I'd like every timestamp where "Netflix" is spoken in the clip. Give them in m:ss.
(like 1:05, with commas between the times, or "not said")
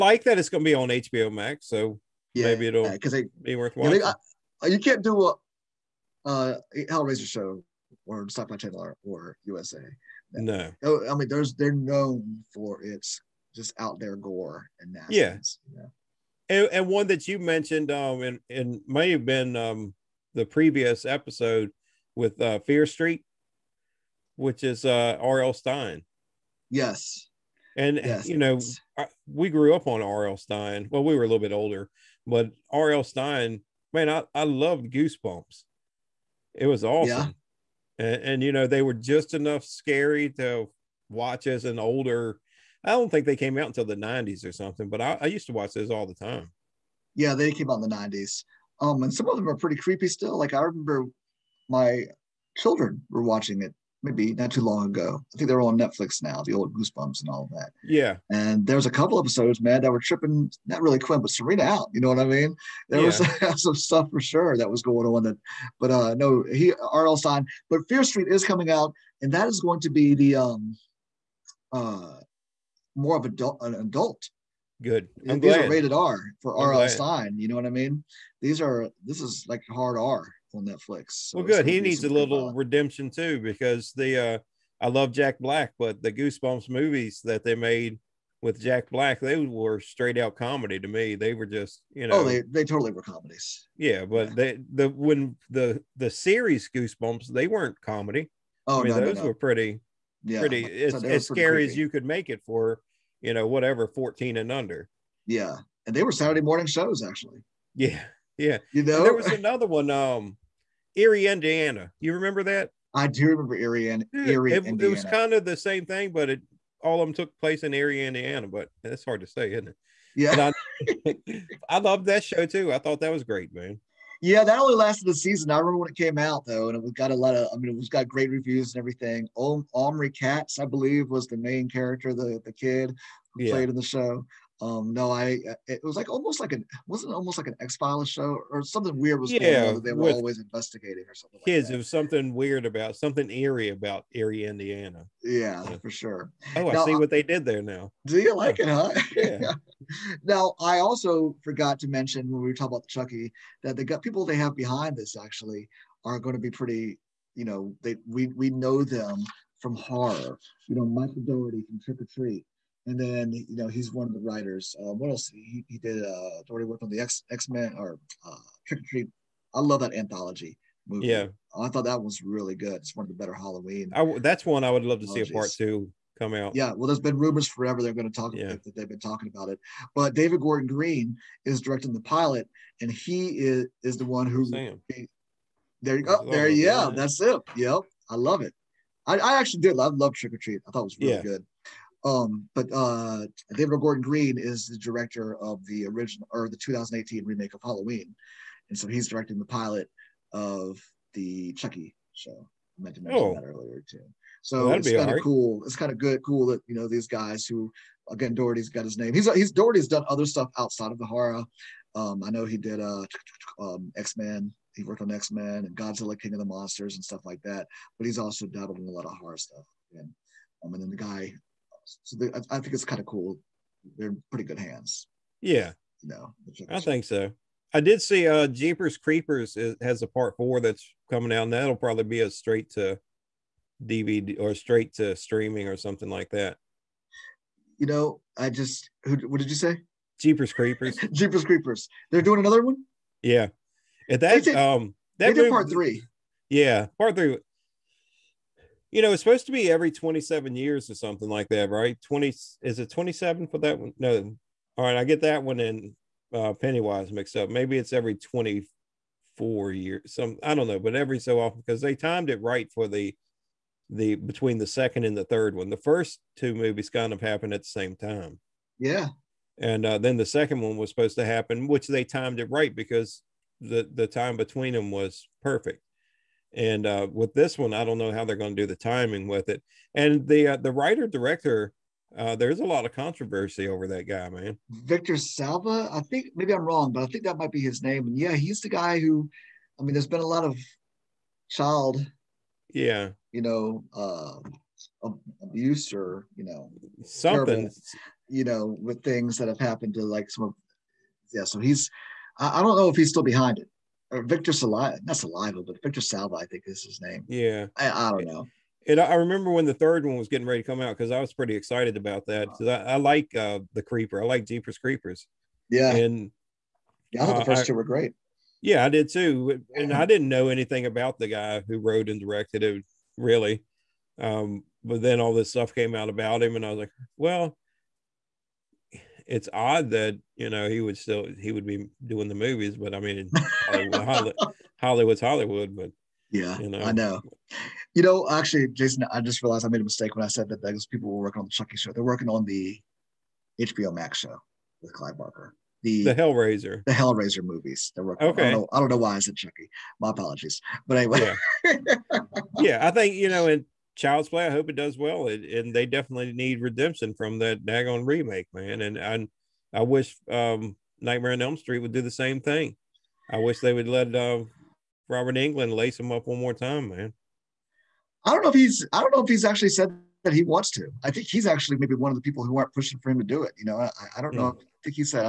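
0:55, 1:20.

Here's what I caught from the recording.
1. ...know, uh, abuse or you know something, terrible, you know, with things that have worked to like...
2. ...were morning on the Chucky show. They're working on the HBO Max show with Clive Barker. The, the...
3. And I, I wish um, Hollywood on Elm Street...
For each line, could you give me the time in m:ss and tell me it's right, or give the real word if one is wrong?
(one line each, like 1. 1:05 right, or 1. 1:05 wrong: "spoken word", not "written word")
1. 4:53 wrong: "happened", not "worked"
2. 5:41 wrong: "working", not "morning"
3. 5:58 wrong: "Nightmare", not "Hollywood".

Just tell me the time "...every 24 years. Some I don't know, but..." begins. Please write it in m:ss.
4:17.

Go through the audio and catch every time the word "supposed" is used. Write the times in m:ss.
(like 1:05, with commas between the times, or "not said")
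4:09, 4:30.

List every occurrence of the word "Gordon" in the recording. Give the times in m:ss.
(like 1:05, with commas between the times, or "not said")
3:00, 3:13.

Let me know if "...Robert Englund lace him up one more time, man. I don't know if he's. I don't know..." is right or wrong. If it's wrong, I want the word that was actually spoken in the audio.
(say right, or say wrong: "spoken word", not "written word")
right.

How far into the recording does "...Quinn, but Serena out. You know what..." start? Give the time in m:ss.
1:00.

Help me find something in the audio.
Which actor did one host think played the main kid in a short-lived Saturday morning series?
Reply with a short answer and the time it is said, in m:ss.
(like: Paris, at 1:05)
Omri Katz, at 2:09.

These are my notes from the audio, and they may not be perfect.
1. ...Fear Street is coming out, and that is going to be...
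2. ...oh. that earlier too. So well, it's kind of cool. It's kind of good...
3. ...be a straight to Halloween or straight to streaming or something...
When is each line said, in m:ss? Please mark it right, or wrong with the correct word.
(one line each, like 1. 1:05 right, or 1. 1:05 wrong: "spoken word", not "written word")
1. 1:07 right
2. 3:23 right
3. 3:52 wrong: "DVD", not "Halloween".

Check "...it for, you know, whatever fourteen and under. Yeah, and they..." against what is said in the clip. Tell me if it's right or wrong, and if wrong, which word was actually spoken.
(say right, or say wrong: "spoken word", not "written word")
right.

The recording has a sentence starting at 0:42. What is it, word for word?
I don't think they came out until the 90s or something, but I, I used to watch those all the time.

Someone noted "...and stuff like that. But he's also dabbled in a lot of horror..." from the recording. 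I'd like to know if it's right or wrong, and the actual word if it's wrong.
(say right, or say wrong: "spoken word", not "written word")
right.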